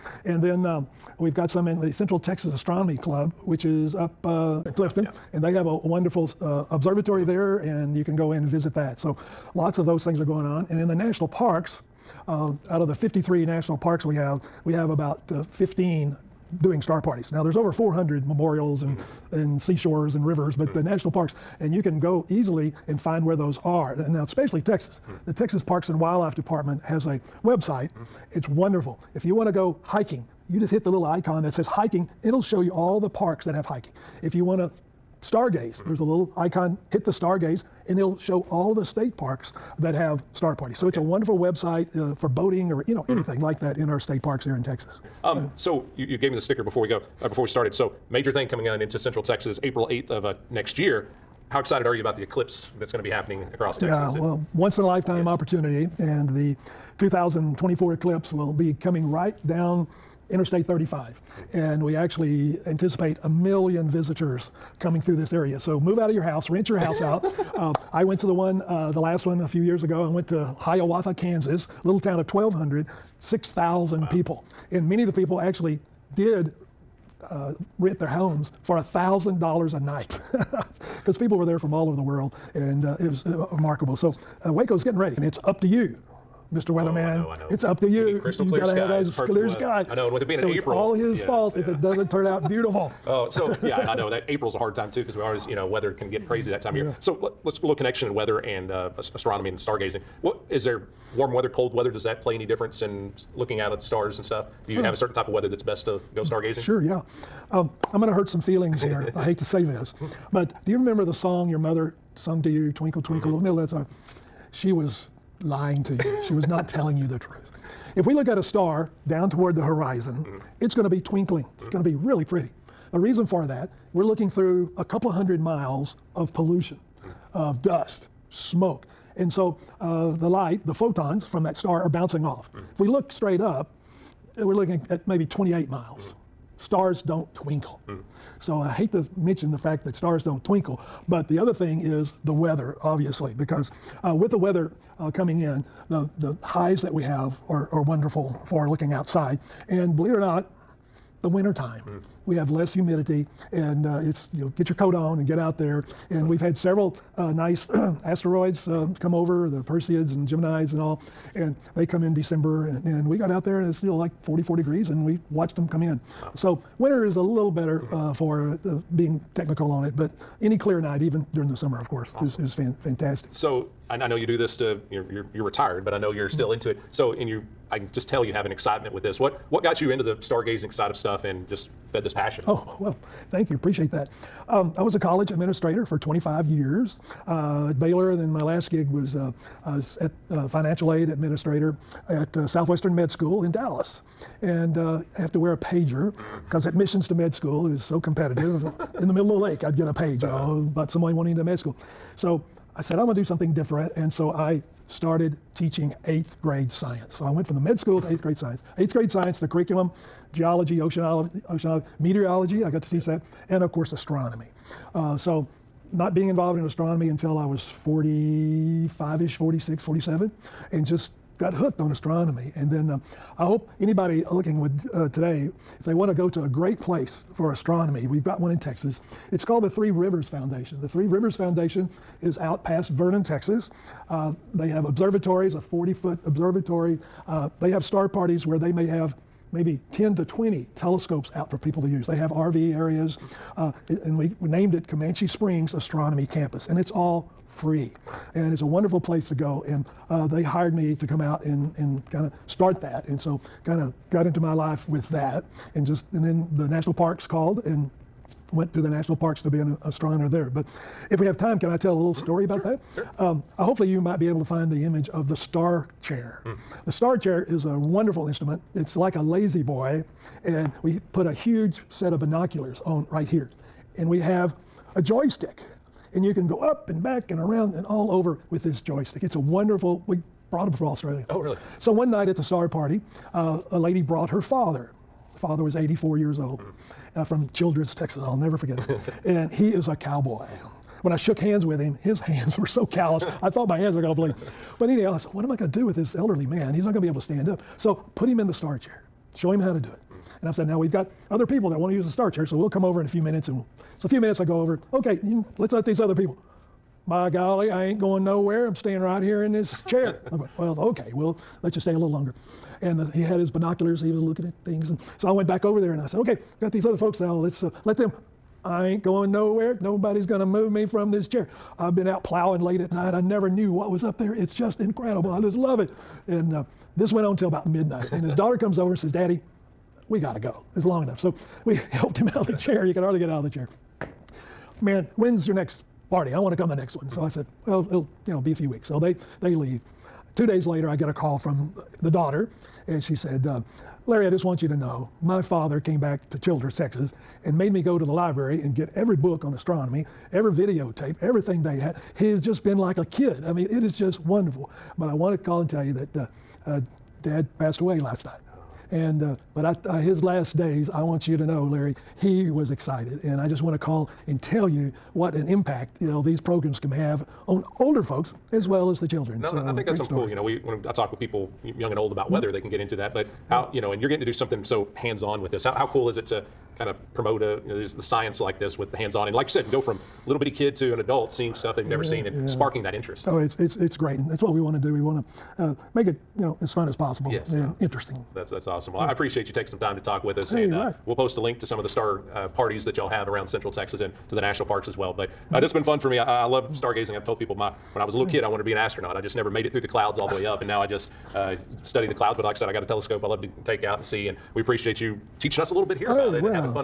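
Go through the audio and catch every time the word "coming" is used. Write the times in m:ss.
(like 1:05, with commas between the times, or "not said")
0:48, 0:58, 1:04, 2:25.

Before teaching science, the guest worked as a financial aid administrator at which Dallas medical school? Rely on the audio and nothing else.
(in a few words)
Southwestern Med School.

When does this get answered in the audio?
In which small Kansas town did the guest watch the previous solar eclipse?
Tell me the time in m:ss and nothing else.
1:10.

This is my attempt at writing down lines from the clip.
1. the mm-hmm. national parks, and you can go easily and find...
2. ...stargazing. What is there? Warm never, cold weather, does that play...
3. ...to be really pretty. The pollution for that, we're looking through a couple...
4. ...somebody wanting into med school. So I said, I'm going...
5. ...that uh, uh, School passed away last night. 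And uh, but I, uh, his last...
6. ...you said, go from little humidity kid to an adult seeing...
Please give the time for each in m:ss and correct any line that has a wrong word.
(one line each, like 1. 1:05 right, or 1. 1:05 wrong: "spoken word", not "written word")
1. 0:20 right
2. 1:39 wrong: "weather", not "never"
3. 2:01 wrong: "reason", not "pollution"
4. 3:20 right
5. 5:55 wrong: "Dad", not "School"
6. 6:19 wrong: "bitty", not "humidity".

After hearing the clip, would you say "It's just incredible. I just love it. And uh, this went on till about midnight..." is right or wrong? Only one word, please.
right.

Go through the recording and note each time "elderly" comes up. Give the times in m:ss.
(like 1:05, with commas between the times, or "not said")
4:56.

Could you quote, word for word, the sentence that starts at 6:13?
But how you know, and you're getting to do something so hands-on with this.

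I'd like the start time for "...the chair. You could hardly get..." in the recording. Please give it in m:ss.
5:32.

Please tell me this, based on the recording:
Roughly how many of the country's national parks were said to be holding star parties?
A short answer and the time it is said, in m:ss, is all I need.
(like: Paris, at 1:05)
15, at 0:15.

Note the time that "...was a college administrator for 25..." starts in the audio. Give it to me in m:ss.
3:04.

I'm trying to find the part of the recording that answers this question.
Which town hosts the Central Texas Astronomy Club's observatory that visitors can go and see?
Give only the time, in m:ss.
0:04.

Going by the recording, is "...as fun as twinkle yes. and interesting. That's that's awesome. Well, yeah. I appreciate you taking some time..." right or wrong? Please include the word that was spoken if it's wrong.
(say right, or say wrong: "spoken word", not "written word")
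wrong: "possible", not "twinkle".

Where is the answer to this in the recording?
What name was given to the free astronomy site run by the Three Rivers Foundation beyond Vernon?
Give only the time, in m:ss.
4:04.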